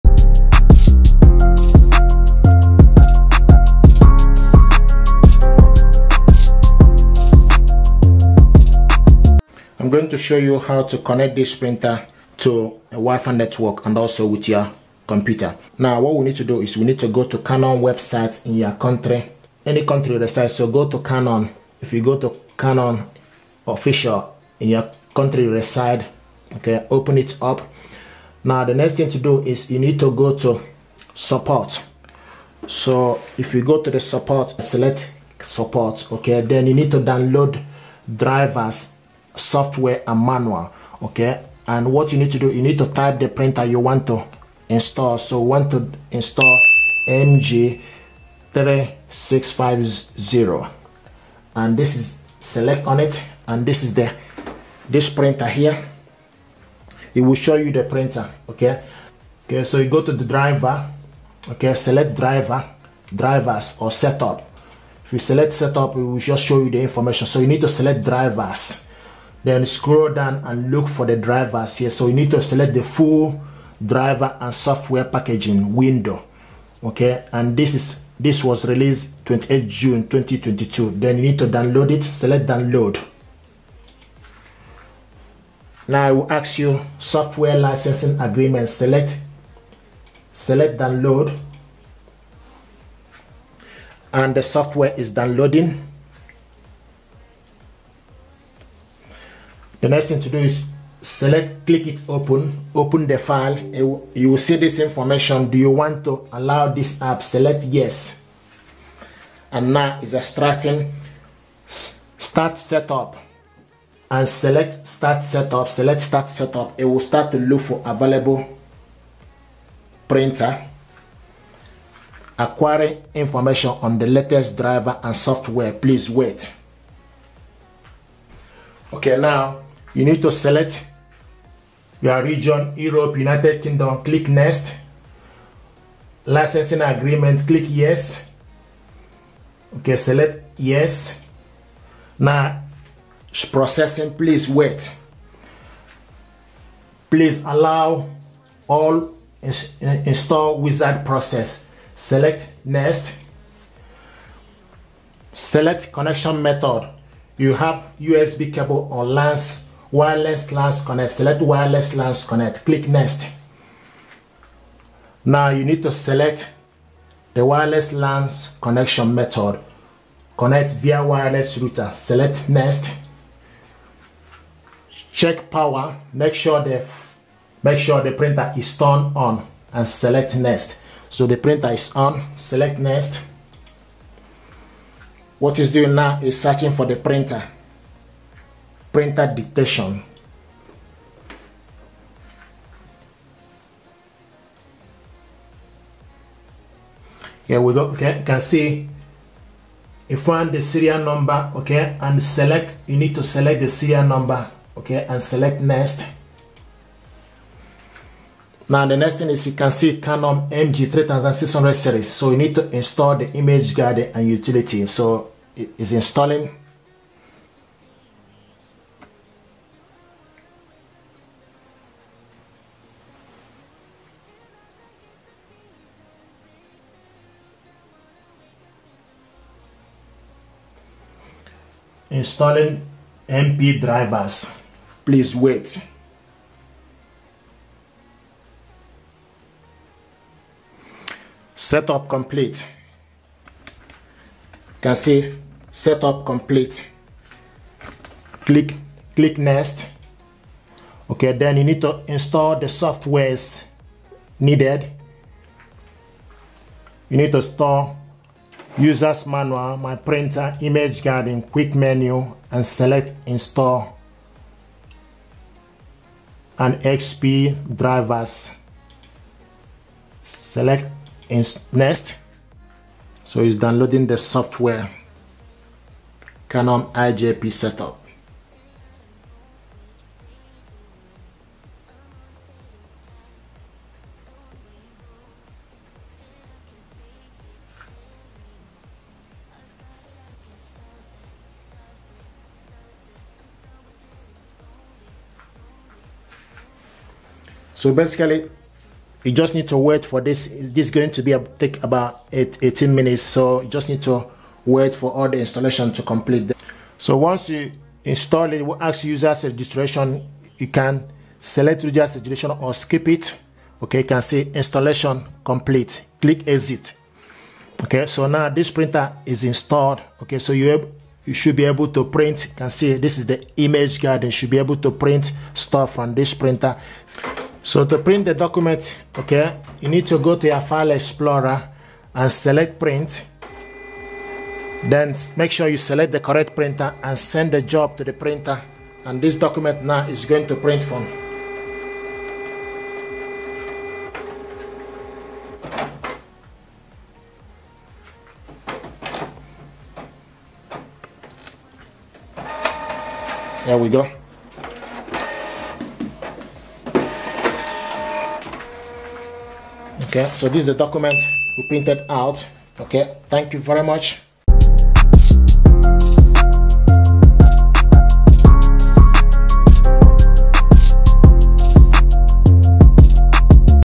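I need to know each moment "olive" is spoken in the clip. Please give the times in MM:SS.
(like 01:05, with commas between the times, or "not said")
not said.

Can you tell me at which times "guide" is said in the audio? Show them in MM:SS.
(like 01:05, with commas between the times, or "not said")
03:33, 05:23.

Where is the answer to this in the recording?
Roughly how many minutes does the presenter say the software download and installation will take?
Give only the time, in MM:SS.
05:02.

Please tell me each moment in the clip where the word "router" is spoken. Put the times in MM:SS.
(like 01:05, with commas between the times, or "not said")
02:51.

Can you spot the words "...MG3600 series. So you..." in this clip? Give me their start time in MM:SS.
03:30.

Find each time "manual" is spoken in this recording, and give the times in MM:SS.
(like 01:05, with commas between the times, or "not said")
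00:40, 04:19.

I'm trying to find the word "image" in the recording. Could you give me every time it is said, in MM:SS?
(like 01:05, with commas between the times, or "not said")
03:33, 04:20, 05:23.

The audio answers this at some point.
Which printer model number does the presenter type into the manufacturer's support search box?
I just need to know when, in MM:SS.
00:47.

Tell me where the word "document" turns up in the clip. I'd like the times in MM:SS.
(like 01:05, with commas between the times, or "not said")
05:28, 05:39, 06:00.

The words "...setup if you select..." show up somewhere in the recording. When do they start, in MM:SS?
01:03.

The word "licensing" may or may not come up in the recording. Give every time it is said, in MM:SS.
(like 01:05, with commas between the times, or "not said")
01:27, 02:16.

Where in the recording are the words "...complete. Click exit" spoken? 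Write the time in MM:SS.
05:15.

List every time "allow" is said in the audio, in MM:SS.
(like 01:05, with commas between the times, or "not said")
01:46, 02:27.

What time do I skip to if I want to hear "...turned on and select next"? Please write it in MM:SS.
02:58.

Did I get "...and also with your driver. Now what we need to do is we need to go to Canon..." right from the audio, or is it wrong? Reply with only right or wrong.
wrong.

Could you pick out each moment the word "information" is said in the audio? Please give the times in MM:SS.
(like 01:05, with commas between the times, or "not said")
01:06, 01:44, 02:03.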